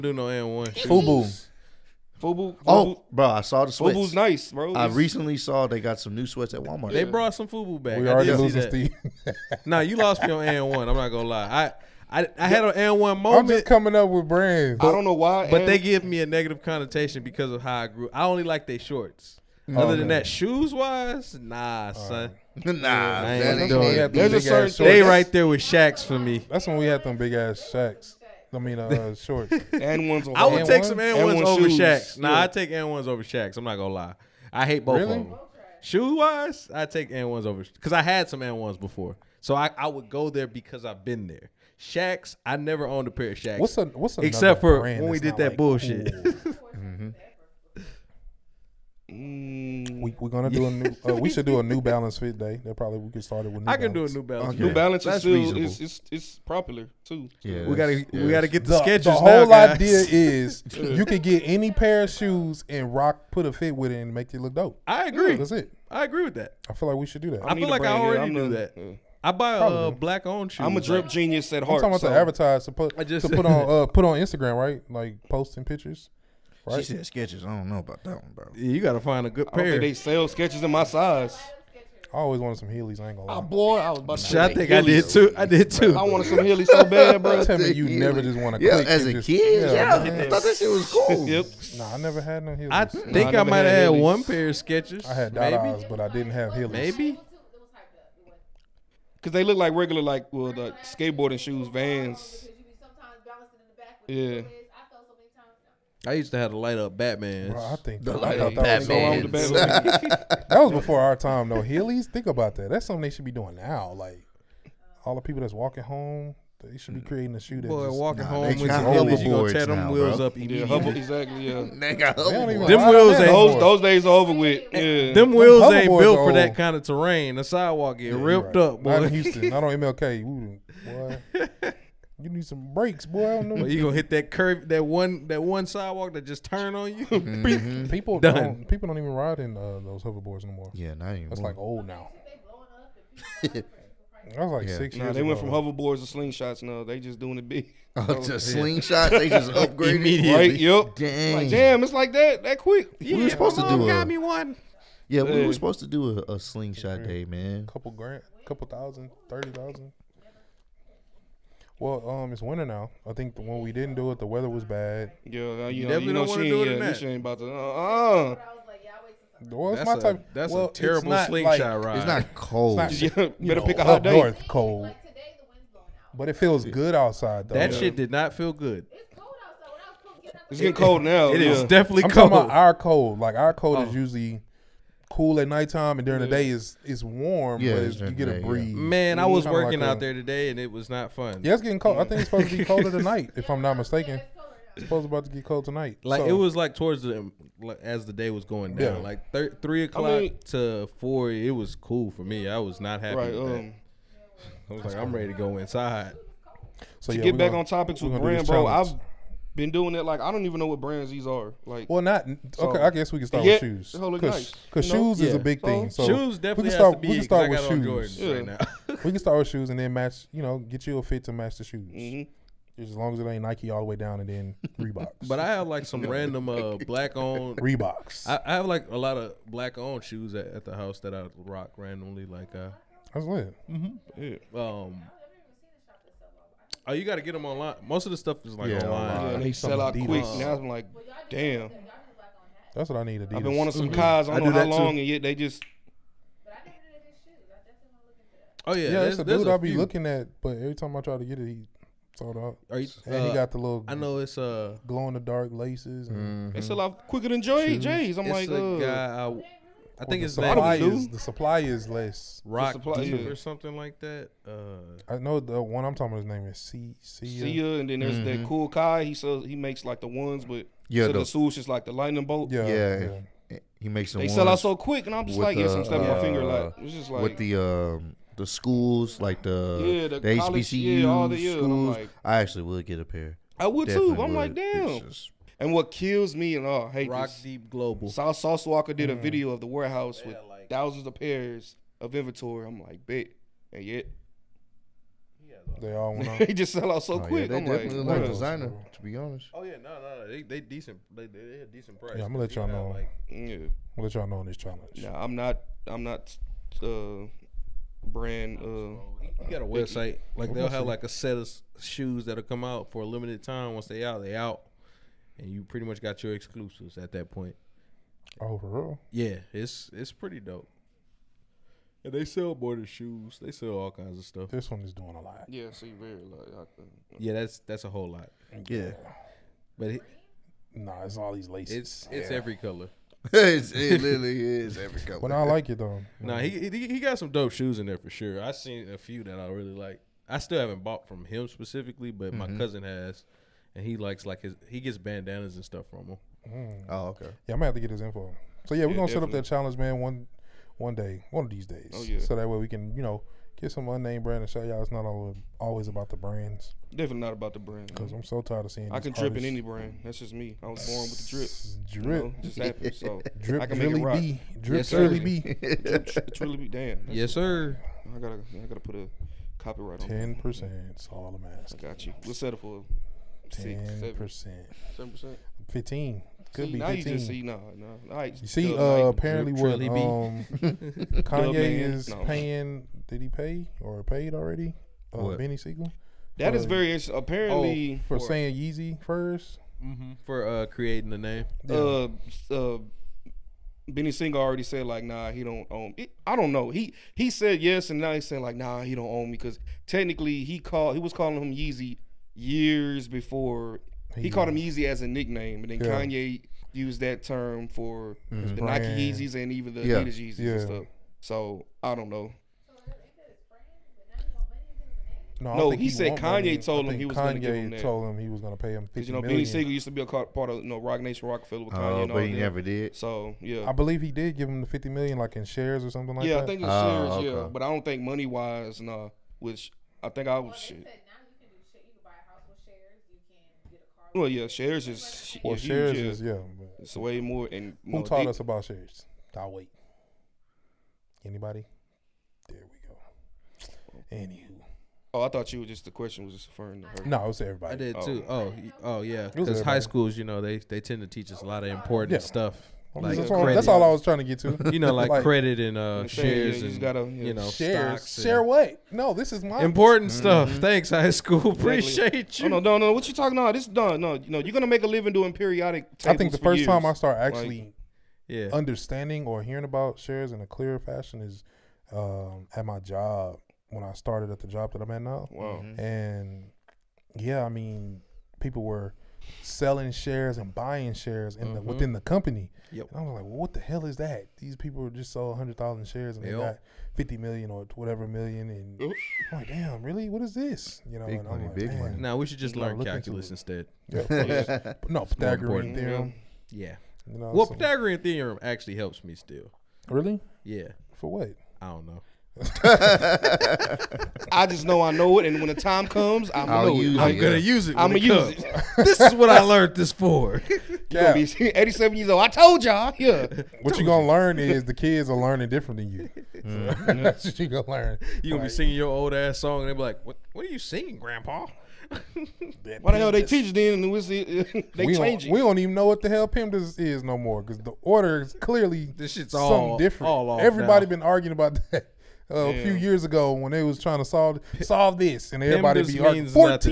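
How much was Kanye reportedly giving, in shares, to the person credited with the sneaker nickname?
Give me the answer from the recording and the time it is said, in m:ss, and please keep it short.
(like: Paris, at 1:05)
50 million, at 7:04.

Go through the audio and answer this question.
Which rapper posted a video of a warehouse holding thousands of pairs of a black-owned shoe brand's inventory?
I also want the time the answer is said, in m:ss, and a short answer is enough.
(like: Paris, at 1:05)
Sauce Walka, at 4:48.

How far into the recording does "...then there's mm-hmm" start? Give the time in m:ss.
4:27.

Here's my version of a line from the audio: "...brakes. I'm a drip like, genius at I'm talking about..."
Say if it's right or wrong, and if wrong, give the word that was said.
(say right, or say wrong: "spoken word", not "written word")
wrong: "shoes", not "brakes".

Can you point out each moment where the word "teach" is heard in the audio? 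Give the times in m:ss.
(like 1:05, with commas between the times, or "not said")
7:31, 8:43.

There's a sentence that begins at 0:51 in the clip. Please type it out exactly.
Uh, we should do a New Balance fit day.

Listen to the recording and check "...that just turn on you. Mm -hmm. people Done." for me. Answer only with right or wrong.
right.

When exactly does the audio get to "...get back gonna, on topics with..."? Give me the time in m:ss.
3:27.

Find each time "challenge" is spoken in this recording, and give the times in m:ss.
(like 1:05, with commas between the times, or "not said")
5:04, 5:49.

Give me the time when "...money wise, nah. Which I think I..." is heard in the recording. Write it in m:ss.
7:08.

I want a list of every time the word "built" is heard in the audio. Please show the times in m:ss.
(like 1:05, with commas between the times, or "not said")
2:05.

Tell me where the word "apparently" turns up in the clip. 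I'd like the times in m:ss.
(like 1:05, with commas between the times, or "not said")
6:19, 6:27.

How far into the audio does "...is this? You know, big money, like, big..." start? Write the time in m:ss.
8:10.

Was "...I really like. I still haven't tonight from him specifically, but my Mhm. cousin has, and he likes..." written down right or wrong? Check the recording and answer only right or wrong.
wrong.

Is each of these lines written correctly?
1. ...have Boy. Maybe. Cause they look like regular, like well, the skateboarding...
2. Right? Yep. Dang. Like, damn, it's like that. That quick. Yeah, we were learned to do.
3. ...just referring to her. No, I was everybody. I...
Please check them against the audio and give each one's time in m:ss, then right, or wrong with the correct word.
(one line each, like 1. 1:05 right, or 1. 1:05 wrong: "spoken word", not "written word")
1. 1:36 wrong: "Heelys", not "Boy"
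2. 2:30 wrong: "supposed", not "learned"
3. 7:26 right.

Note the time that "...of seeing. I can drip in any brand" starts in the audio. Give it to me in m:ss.
5:58.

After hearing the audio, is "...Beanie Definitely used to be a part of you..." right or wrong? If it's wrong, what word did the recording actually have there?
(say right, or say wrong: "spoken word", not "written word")
wrong: "Sigel", not "Definitely".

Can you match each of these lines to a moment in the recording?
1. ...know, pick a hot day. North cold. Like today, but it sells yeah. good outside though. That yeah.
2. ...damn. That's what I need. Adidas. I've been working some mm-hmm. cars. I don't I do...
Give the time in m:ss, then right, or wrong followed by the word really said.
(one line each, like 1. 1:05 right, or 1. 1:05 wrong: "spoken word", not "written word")
1. 2:53 wrong: "feels", not "sells"
2. 4:01 wrong: "wanting", not "working".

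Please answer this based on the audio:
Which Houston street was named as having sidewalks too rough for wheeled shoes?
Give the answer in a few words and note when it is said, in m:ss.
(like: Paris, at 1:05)
MLK, at 2:09.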